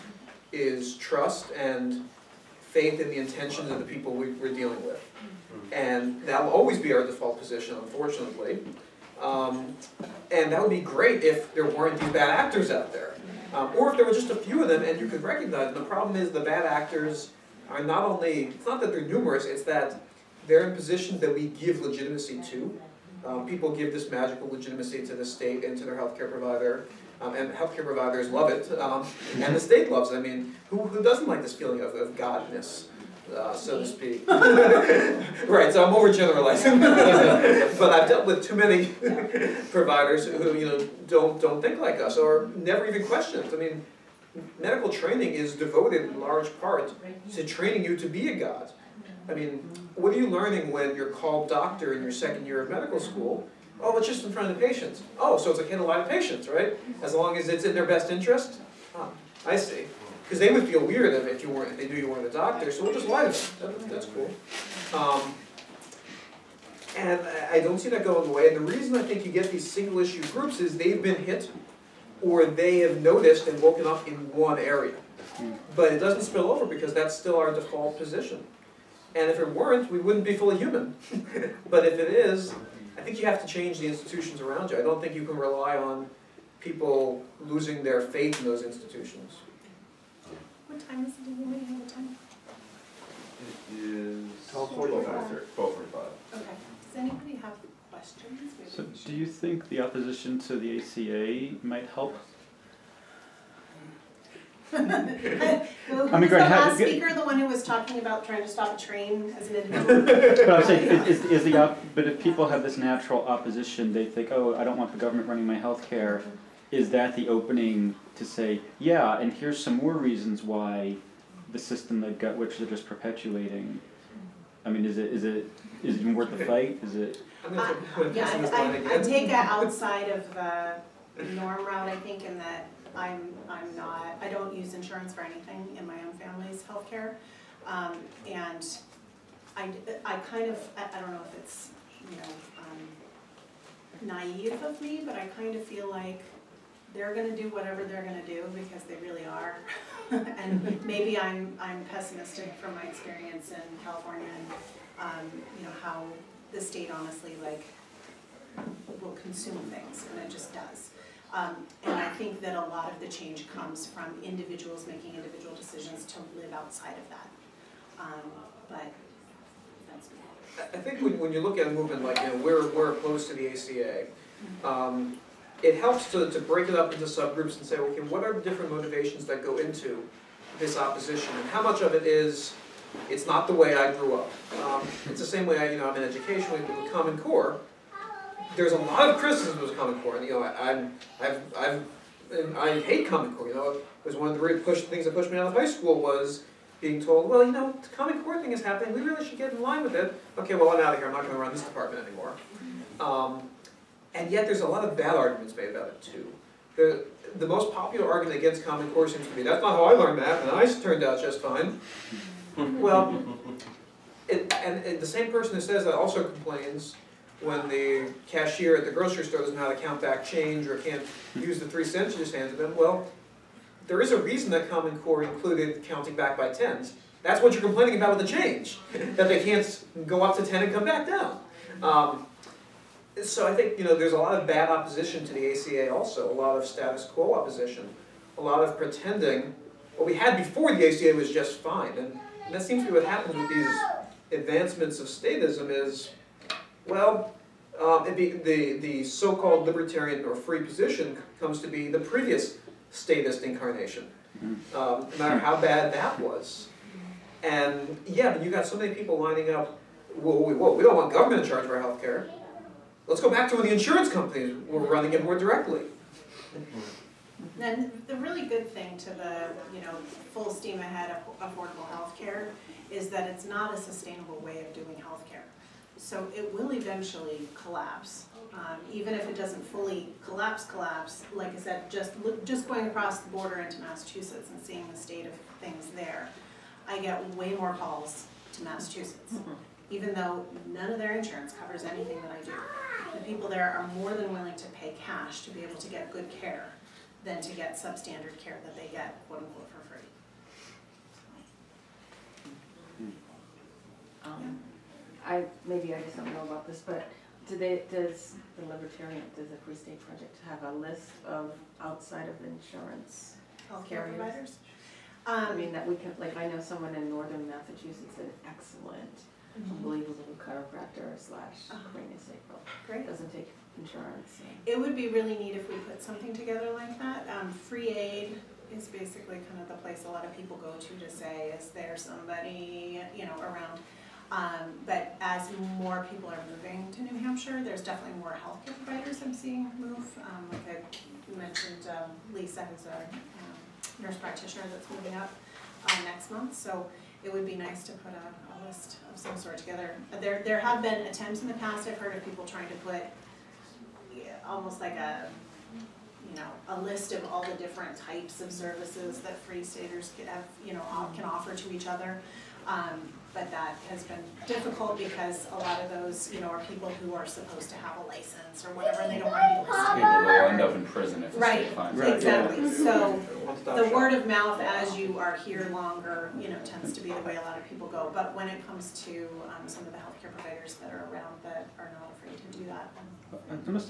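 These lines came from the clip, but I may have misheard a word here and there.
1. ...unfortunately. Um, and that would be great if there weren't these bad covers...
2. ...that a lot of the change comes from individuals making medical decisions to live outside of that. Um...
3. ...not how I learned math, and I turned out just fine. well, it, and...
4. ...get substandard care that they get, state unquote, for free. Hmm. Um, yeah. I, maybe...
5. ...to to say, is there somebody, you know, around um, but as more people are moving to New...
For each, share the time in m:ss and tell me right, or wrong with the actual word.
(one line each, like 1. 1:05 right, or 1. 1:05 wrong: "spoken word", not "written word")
1. 0:07 wrong: "actors", not "covers"
2. 2:42 wrong: "individual", not "medical"
3. 3:29 right
4. 4:57 wrong: "quote", not "state"
5. 5:30 right.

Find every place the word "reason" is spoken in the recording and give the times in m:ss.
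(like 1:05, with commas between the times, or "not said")
1:08, 1:59, 3:44.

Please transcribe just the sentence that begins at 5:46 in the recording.
So it would be nice to put a, a list of some sort together.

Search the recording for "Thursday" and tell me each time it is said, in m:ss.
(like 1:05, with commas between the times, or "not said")
not said.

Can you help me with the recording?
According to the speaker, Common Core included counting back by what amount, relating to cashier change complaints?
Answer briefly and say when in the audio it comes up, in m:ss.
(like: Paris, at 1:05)
tens, at 3:45.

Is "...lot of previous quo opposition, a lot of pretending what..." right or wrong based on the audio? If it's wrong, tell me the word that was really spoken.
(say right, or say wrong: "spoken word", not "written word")
wrong: "status", not "previous".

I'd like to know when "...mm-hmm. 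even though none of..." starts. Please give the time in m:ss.
4:49.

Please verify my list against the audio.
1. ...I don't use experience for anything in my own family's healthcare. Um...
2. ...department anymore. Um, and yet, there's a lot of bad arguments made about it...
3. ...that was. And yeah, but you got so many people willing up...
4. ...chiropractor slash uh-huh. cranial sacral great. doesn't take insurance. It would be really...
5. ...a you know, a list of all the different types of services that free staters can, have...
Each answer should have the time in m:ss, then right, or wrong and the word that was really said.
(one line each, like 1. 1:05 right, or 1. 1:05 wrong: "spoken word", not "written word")
1. 2:14 wrong: "insurance", not "experience"
2. 3:21 right
3. 4:15 wrong: "lining", not "willing"
4. 5:20 right
5. 5:54 right.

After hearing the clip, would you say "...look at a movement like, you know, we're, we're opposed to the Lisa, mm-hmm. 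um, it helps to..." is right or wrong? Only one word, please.
wrong.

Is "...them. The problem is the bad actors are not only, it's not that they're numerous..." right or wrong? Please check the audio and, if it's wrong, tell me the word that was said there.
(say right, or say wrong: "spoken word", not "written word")
right.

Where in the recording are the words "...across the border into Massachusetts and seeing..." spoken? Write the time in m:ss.
4:42.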